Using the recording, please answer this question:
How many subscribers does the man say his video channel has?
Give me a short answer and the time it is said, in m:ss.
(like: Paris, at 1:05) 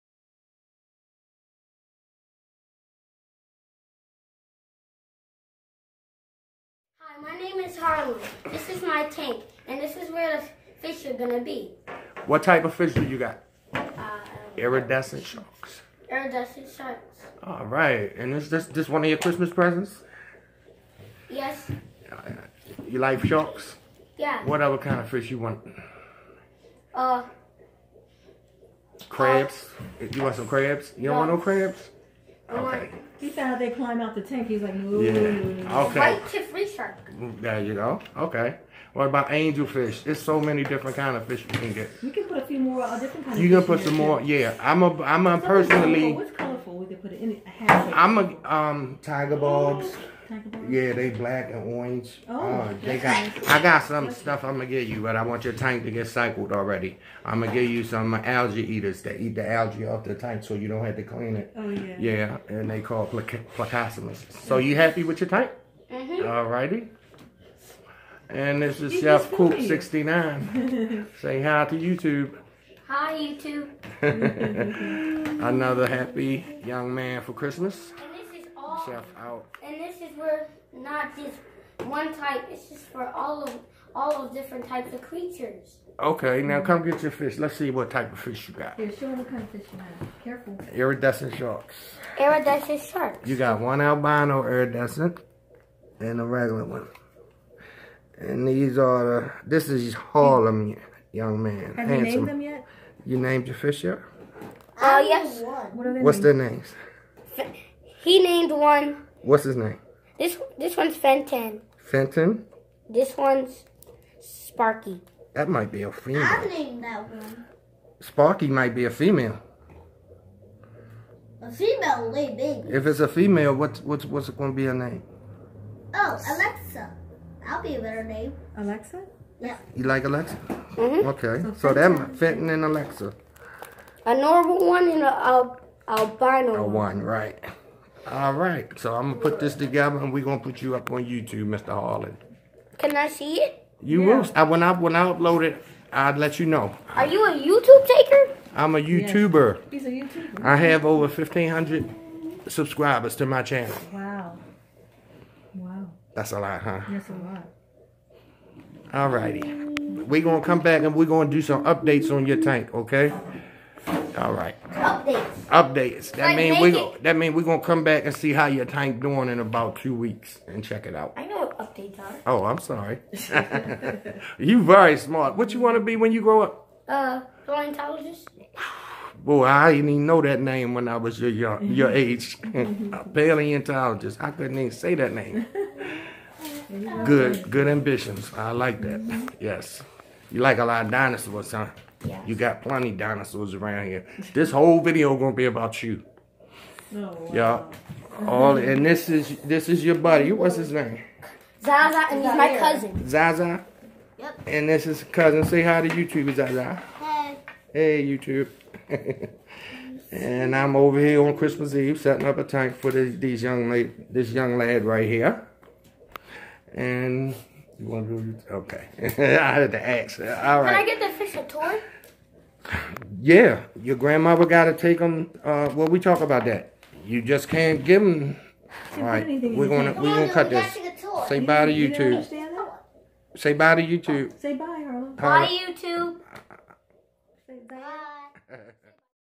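Over 1,500, at 2:30.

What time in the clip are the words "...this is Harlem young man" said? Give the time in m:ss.
1:39.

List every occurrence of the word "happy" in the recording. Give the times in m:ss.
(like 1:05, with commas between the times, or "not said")
1:04, 1:15.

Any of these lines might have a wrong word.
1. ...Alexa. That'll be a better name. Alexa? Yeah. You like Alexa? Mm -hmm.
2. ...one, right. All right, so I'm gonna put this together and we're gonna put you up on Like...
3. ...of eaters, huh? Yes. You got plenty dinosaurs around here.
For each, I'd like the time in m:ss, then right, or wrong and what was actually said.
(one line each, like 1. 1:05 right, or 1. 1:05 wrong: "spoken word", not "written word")
1. 2:06 right
2. 2:16 wrong: "YouTube", not "Like"
3. 3:10 wrong: "dinosaurs", not "eaters".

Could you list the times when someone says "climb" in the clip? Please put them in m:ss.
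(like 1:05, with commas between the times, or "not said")
0:33.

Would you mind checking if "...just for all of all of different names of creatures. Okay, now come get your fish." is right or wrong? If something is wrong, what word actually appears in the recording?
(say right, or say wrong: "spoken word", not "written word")
wrong: "types", not "names".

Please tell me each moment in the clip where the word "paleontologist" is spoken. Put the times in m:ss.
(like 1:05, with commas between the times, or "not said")
2:57, 3:03.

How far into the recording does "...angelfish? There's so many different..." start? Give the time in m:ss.
0:39.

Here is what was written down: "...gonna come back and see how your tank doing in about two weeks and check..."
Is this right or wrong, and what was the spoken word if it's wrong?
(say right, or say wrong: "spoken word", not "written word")
right.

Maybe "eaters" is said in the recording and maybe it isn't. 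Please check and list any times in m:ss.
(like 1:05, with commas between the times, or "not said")
0:58.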